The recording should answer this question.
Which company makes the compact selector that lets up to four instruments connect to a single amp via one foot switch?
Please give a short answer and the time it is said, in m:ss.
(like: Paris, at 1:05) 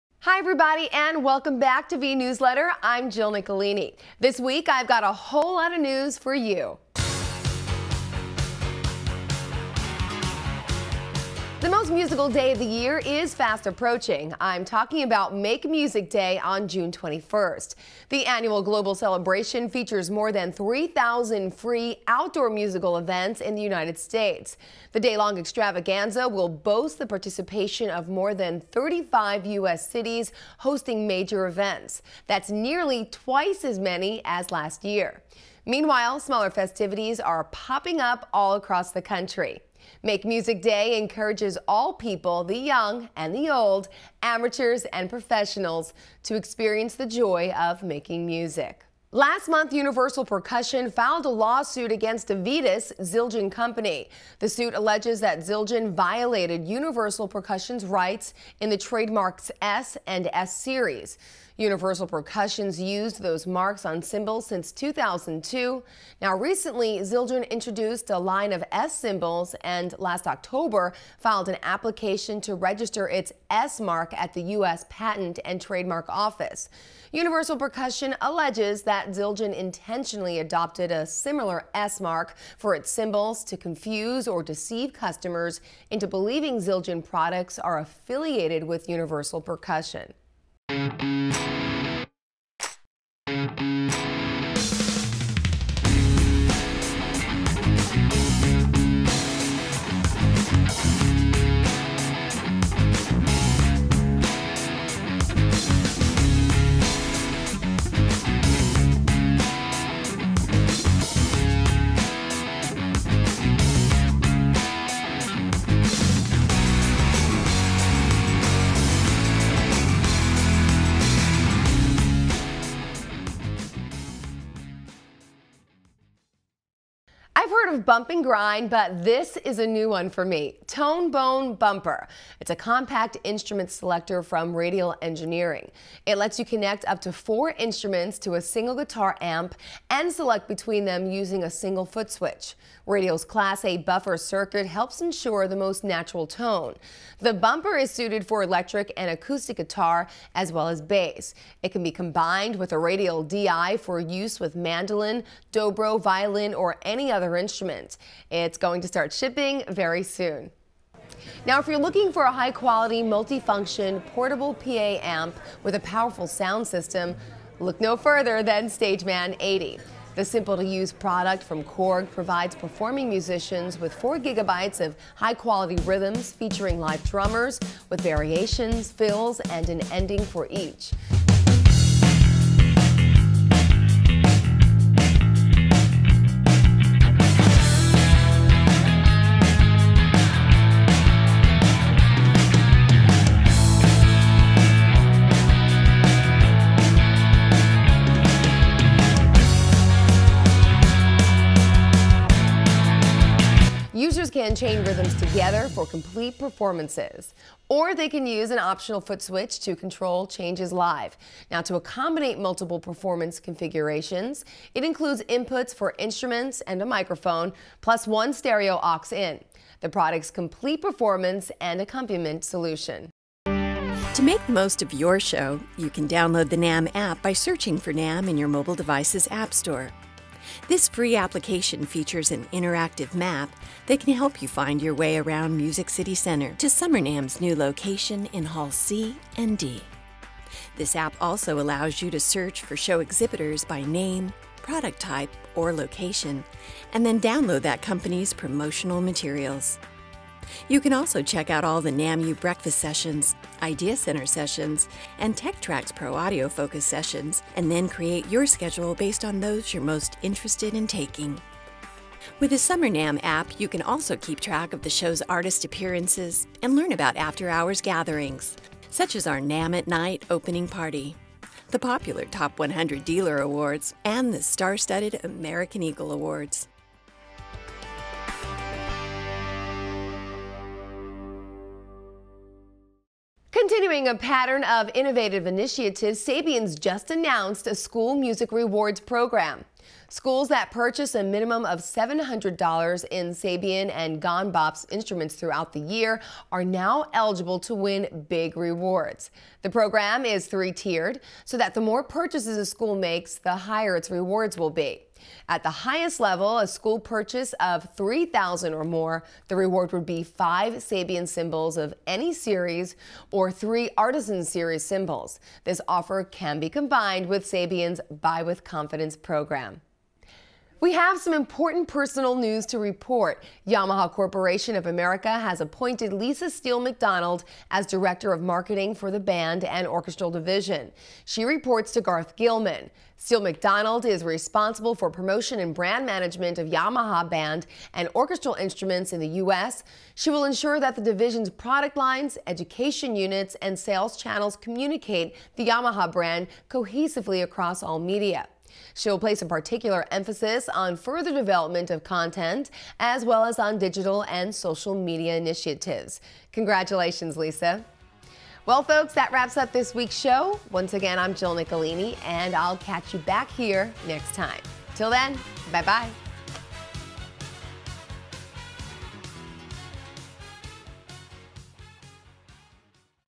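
Radial Engineering, at 2:14.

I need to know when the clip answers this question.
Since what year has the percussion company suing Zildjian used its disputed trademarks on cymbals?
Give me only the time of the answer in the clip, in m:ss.
1:04.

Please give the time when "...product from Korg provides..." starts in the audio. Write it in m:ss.
2:50.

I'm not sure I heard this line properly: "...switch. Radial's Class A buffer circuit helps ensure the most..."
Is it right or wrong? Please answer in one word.
right.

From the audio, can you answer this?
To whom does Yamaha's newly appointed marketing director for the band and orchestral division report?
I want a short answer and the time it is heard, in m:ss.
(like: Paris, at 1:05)
Garth Gilman, at 5:32.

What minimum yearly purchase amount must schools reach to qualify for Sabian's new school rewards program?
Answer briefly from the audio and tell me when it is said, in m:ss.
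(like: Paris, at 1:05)
$700, at 4:51.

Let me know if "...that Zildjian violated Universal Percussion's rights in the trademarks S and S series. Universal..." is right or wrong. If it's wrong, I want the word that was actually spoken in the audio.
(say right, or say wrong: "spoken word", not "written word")
right.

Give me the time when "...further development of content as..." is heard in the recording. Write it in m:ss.
5:50.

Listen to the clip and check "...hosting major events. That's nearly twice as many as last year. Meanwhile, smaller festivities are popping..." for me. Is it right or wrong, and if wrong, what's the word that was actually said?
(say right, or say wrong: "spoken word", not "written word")
right.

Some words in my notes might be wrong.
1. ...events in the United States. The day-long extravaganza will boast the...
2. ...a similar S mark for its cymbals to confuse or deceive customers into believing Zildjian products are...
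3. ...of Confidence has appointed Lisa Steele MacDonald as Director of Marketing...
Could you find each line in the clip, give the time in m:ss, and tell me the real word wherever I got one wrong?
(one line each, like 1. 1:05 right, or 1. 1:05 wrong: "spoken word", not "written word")
1. 0:22 right
2. 1:20 right
3. 5:24 wrong: "America", not "Confidence".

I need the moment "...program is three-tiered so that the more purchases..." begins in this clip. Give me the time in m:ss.
4:59.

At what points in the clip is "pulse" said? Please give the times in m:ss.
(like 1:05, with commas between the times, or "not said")
not said.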